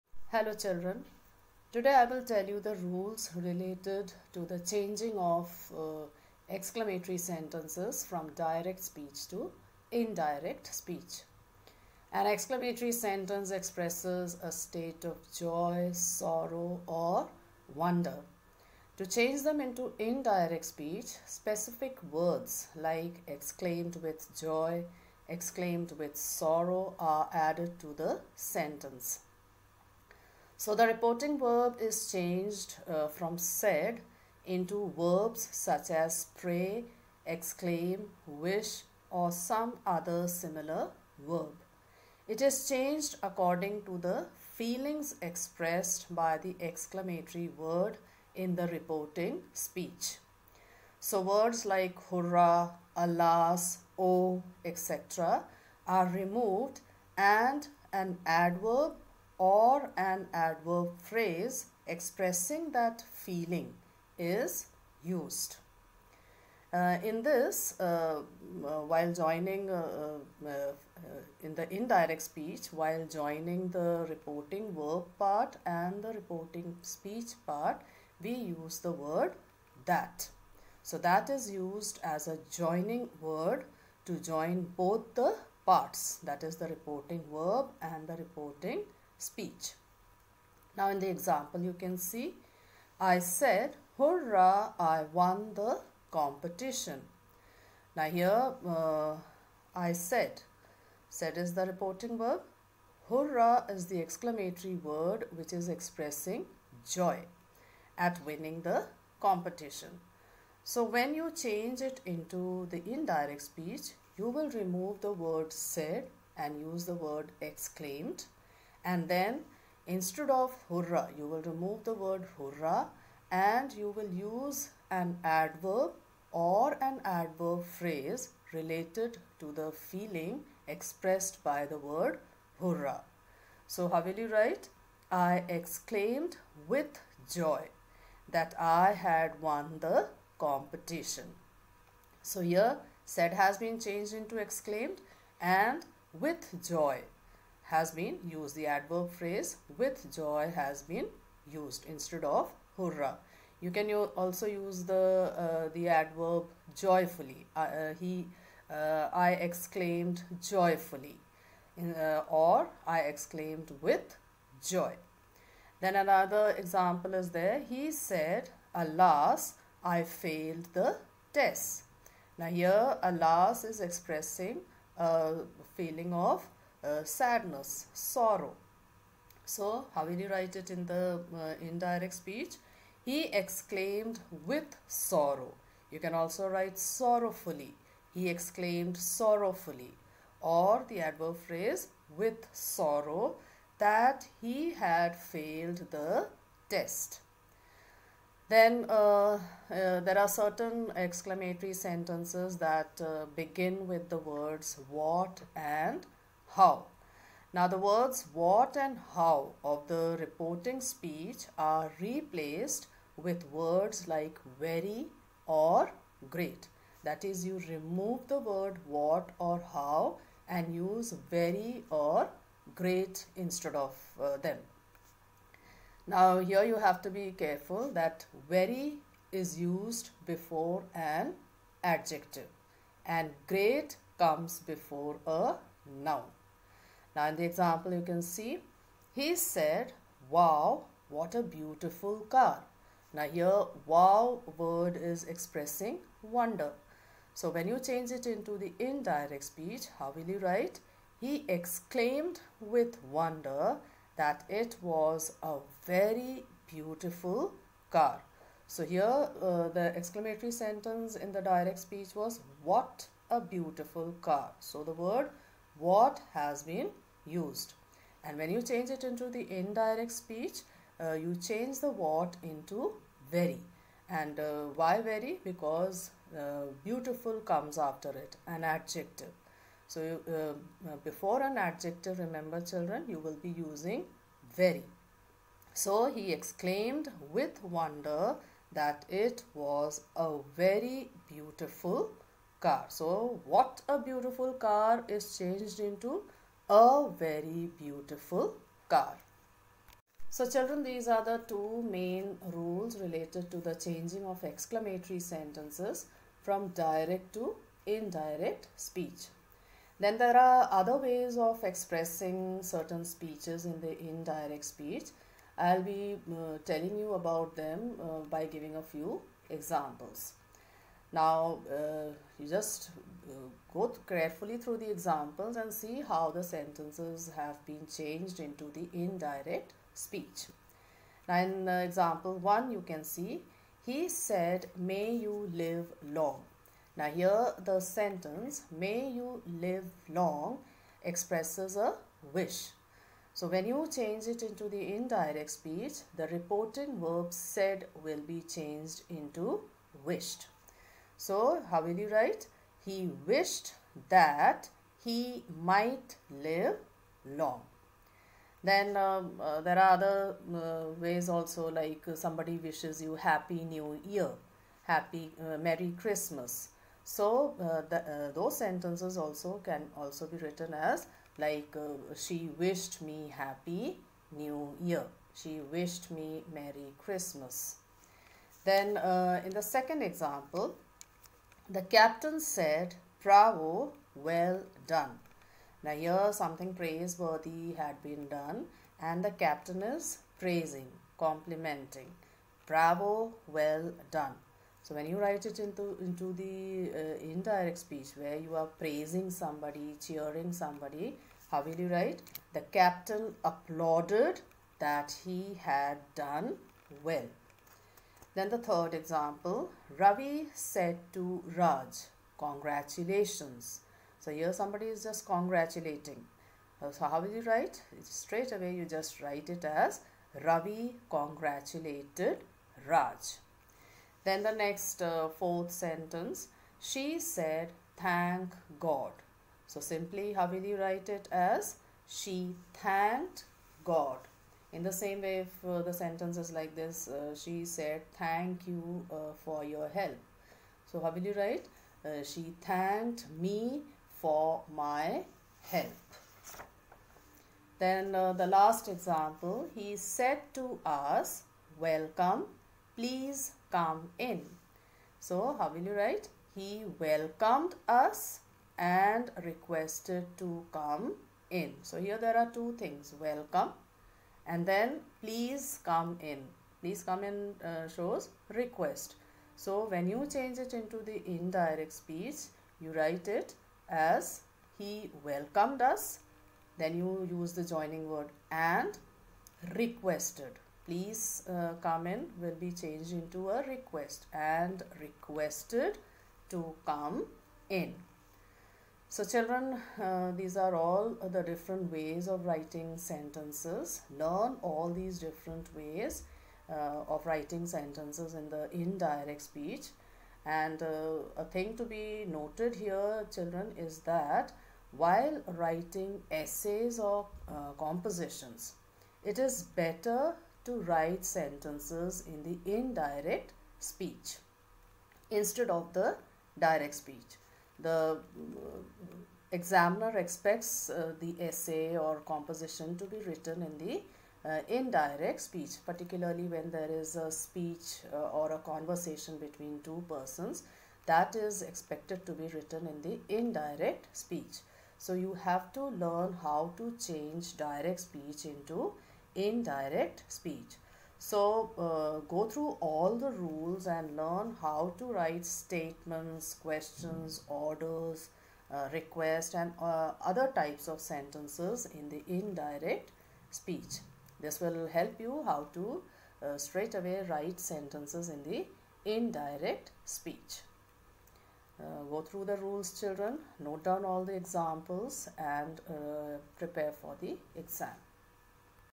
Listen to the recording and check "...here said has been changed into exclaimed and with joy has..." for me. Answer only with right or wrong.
right.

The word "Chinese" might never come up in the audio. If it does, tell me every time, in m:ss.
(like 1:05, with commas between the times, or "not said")
not said.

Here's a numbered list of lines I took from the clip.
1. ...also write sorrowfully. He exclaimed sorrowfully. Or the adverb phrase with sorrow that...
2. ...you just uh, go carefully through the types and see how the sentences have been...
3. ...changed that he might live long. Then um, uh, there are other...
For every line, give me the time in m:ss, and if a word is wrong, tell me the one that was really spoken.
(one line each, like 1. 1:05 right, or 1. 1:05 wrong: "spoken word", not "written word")
1. 3:06 right
2. 5:22 wrong: "examples", not "types"
3. 5:53 wrong: "wished", not "changed".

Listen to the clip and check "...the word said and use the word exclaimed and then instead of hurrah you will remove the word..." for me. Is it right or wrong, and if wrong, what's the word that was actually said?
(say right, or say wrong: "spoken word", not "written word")
right.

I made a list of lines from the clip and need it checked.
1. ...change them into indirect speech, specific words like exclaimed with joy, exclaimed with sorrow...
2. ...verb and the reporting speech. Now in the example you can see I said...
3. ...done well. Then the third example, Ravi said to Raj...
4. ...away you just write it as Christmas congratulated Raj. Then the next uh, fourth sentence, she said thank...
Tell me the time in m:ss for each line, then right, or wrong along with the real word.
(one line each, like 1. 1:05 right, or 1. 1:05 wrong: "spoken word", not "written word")
1. 0:19 right
2. 1:27 right
3. 6:46 right
4. 6:58 wrong: "Ravi", not "Christmas".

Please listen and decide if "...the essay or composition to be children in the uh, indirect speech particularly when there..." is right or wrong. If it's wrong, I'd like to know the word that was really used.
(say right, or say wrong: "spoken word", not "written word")
wrong: "written", not "children".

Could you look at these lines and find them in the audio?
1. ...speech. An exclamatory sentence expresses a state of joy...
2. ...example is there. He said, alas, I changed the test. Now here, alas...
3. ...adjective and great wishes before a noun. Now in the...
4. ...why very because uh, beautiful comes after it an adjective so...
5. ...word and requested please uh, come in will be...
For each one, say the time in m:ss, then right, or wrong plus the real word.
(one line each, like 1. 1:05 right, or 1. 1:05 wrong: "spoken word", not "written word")
1. 0:10 right
2. 2:46 wrong: "failed", not "changed"
3. 3:51 wrong: "comes", not "wishes"
4. 4:34 right
5. 7:58 right.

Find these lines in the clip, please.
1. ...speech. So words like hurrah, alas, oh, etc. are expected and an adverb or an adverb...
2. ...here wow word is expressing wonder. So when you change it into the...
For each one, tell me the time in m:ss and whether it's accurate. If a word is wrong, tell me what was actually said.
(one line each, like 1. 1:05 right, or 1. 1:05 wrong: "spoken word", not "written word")
1. 0:49 wrong: "removed", not "expected"
2. 4:03 right.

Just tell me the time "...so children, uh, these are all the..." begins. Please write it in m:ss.
8:09.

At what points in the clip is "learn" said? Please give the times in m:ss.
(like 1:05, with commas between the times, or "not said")
8:14, 8:56, 9:04.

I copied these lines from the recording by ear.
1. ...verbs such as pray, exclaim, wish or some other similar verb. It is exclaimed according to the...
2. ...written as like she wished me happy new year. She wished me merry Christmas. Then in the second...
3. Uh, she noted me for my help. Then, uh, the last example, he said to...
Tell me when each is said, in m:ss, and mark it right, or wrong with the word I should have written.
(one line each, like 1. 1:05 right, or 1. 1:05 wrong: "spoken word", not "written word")
1. 0:34 wrong: "changed", not "exclaimed"
2. 6:10 right
3. 7:22 wrong: "thanked", not "noted".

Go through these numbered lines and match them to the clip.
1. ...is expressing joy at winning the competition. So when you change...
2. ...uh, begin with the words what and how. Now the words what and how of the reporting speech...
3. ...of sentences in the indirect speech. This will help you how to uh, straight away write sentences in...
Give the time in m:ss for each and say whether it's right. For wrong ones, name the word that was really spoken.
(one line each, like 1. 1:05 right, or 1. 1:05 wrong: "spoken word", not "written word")
1. 1:45 right
2. 3:23 right
3. 9:10 right.